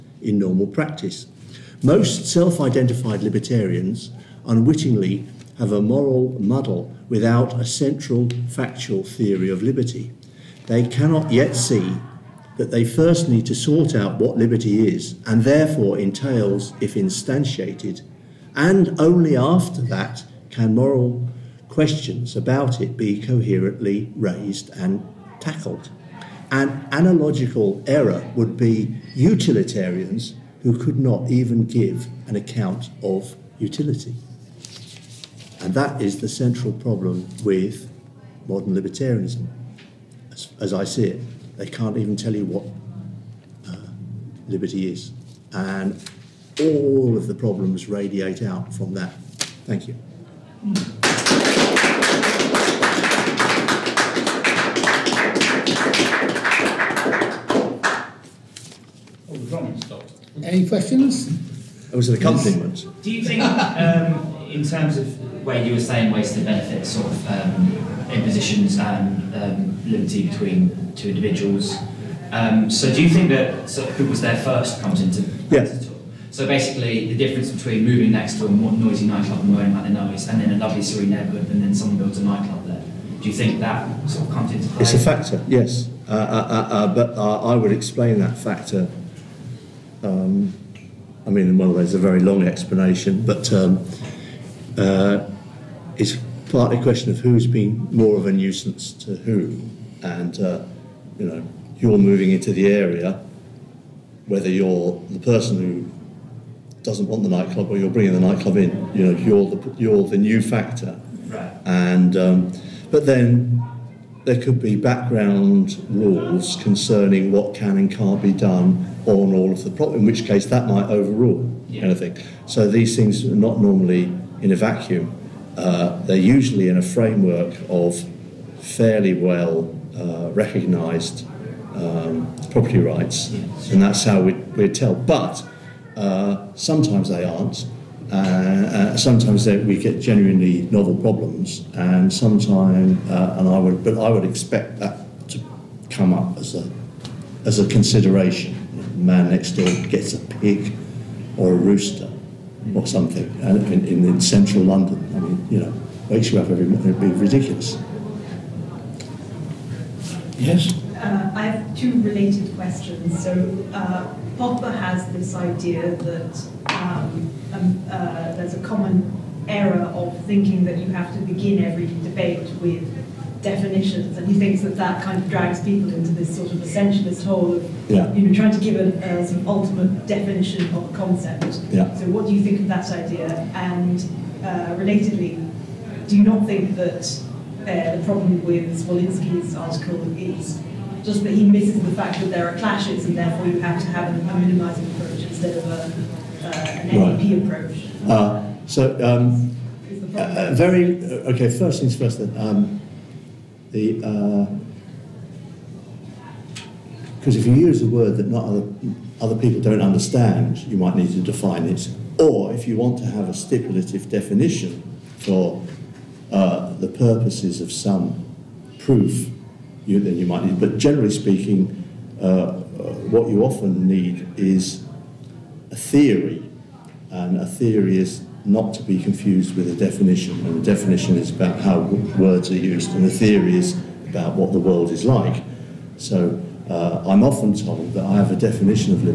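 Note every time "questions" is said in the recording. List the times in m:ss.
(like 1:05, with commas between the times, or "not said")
0:21, 1:00, 1:36, 2:42.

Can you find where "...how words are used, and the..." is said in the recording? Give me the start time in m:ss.
3:51.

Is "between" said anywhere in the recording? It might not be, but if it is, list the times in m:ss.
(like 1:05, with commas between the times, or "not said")
1:10, 1:17.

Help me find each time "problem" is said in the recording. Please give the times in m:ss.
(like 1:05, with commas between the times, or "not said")
0:36, 0:47, 2:20, 3:08.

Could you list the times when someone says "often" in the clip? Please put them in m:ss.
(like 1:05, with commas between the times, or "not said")
3:43, 3:57.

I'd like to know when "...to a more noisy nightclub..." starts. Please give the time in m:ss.
1:18.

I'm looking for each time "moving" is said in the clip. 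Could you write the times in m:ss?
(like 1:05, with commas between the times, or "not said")
1:17, 1:41.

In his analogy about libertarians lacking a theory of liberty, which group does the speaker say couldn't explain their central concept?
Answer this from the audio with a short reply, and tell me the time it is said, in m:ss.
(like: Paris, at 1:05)
utilitarians, at 0:29.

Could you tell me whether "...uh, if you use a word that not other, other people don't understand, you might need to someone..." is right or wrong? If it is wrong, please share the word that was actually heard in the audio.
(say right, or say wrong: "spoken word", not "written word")
wrong: "define", not "someone".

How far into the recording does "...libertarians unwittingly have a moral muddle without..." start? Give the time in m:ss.
0:03.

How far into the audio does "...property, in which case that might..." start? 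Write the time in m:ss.
1:59.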